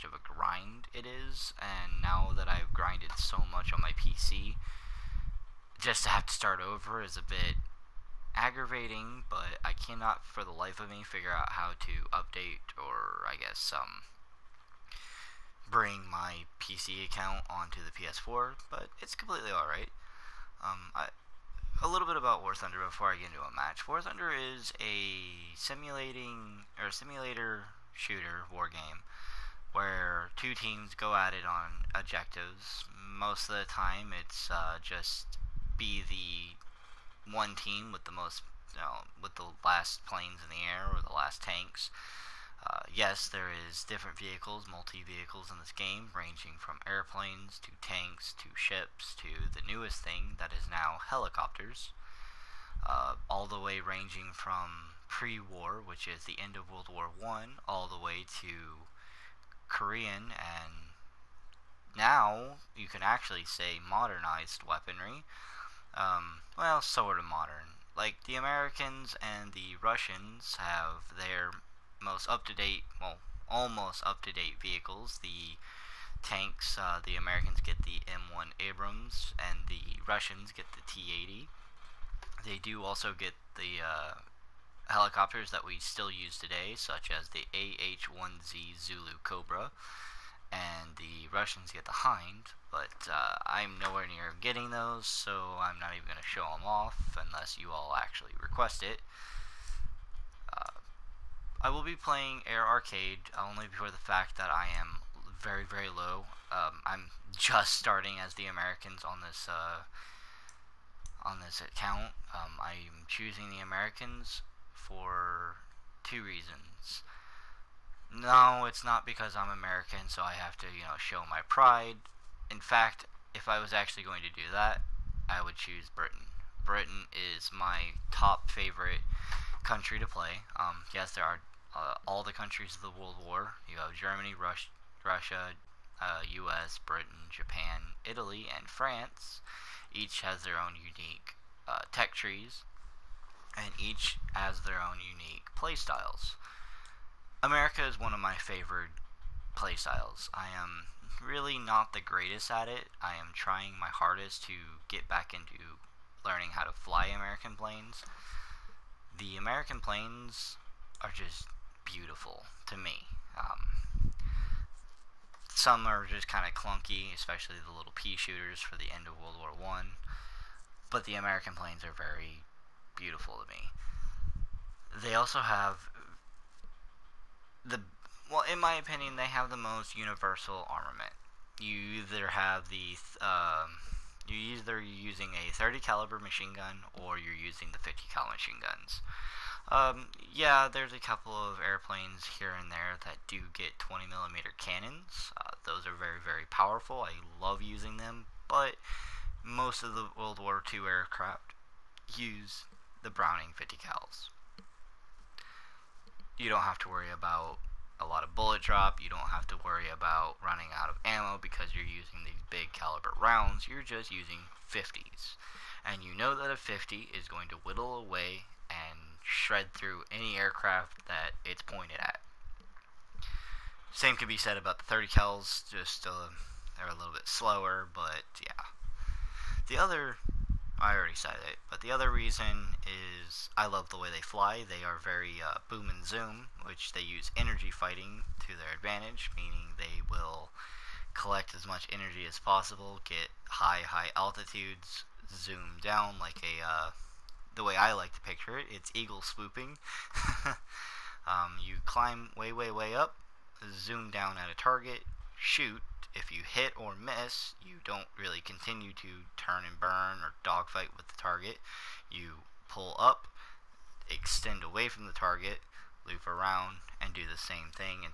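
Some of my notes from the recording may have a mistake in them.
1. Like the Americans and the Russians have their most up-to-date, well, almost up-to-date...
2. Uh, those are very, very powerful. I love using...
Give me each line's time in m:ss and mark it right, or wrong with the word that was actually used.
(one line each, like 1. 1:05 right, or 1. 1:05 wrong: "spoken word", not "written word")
1. 1:07 right
2. 3:15 right.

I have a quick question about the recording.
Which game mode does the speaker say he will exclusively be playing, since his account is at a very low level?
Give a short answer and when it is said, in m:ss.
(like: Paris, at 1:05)
Air Arcade, at 1:42.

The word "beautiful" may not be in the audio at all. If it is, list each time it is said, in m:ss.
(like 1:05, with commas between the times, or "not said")
2:41, 2:52.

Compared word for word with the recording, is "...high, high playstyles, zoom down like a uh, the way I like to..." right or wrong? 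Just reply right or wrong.
wrong.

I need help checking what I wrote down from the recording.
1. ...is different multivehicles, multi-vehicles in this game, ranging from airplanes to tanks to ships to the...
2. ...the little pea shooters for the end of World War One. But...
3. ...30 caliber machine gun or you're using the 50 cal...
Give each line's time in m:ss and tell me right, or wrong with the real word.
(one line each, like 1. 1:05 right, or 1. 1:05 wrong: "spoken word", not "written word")
1. 0:43 wrong: "vehicles", not "multivehicles"
2. 2:47 right
3. 3:05 right.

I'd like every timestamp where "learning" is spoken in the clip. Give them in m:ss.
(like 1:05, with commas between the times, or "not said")
2:36.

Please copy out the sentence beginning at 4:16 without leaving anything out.
If you hit or miss, you don't really continue to turn and burn or dogfight with the target.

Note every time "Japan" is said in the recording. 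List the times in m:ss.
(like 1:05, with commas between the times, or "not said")
2:17.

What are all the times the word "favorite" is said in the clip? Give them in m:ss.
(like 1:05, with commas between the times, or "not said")
2:08, 2:28.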